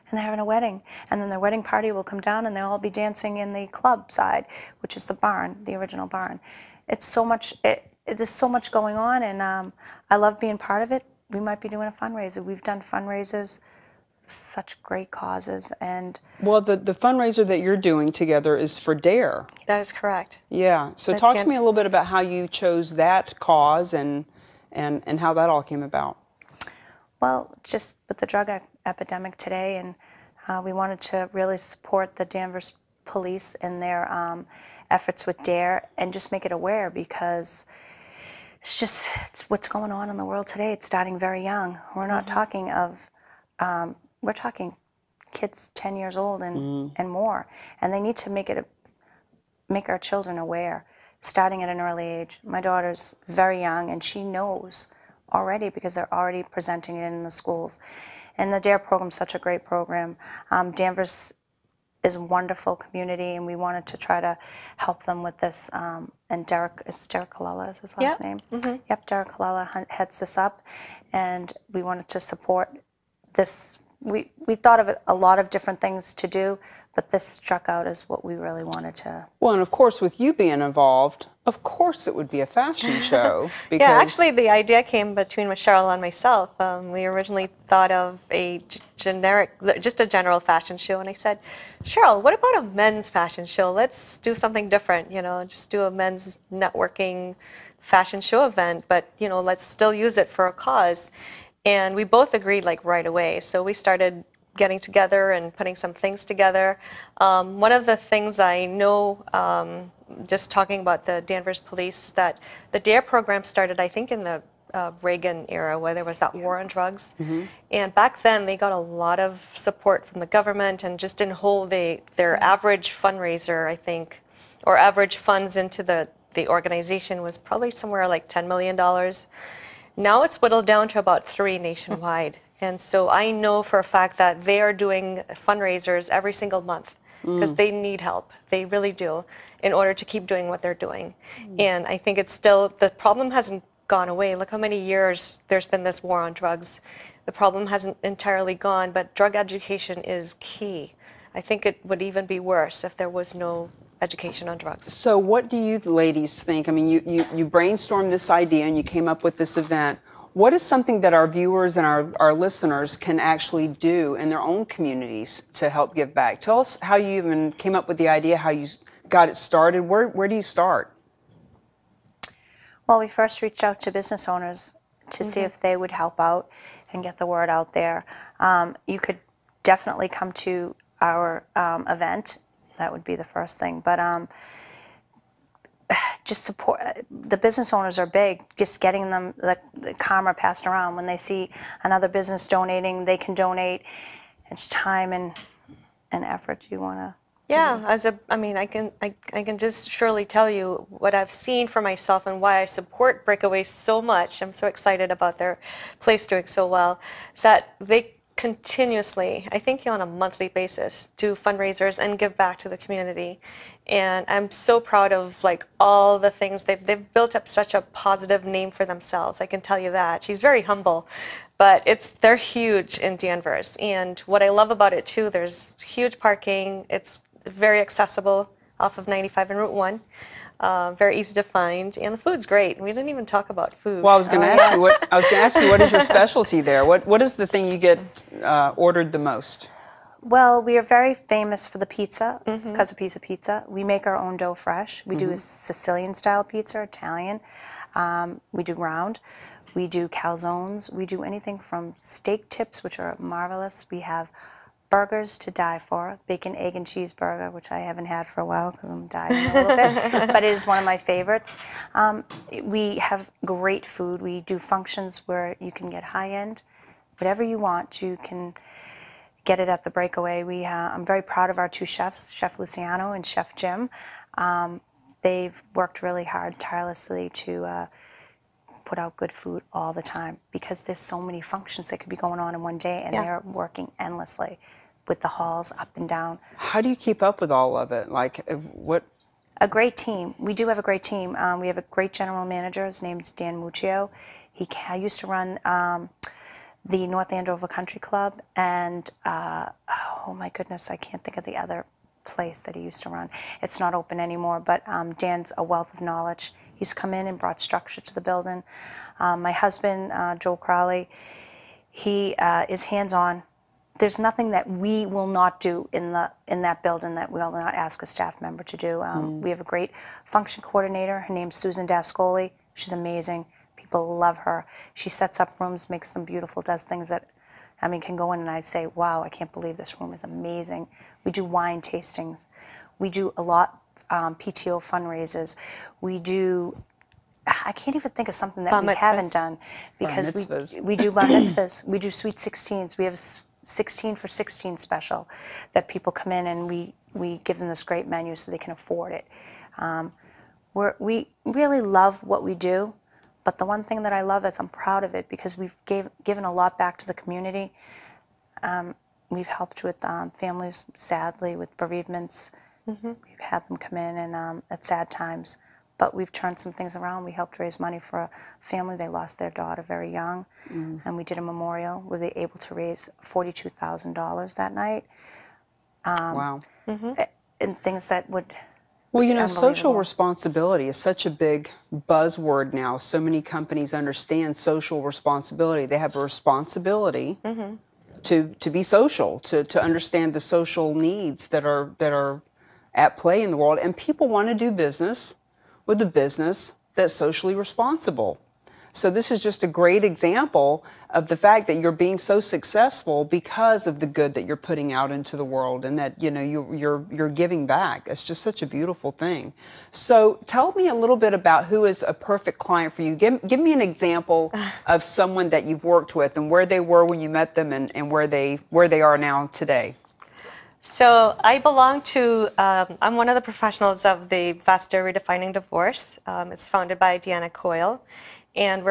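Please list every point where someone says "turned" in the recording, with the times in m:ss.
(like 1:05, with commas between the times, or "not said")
6:06.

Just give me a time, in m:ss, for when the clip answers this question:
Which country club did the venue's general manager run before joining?
4:57.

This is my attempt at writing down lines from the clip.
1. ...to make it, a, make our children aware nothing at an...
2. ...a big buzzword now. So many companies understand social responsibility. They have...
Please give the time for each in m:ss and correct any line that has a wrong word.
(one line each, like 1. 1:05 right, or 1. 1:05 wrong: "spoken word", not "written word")
1. 0:48 wrong: "starting", not "nothing"
2. 6:21 right.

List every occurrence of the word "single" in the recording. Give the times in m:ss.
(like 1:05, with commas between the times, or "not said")
2:16.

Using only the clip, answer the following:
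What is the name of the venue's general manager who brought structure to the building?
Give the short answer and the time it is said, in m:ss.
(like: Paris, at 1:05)
Dan Muccio, at 4:53.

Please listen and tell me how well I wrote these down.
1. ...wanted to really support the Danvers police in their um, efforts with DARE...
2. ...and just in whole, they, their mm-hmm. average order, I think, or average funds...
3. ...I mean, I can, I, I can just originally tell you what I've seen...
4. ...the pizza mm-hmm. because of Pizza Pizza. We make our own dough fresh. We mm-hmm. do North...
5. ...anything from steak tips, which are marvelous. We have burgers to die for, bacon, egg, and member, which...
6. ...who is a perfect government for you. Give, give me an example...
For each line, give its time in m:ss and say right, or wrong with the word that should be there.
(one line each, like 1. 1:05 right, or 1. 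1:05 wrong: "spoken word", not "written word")
1. 0:30 right
2. 2:00 wrong: "fundraiser", not "order"
3. 3:18 wrong: "surely", not "originally"
4. 4:01 wrong: "Sicilian", not "North"
5. 4:11 wrong: "cheeseburger", not "member"
6. 6:51 wrong: "client", not "government".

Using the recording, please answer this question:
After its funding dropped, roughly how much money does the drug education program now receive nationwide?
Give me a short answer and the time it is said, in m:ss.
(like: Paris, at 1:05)
3 million, at 2:10.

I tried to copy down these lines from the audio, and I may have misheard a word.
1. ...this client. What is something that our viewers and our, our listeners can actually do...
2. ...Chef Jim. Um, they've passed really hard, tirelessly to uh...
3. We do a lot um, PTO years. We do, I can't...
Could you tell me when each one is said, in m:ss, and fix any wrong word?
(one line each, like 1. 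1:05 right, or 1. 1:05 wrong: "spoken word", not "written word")
1. 2:39 wrong: "event", not "client"
2. 4:33 wrong: "worked", not "passed"
3. 5:32 wrong: "fundraisers", not "years".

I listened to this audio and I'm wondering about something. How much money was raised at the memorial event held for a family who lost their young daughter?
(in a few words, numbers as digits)
$42,000.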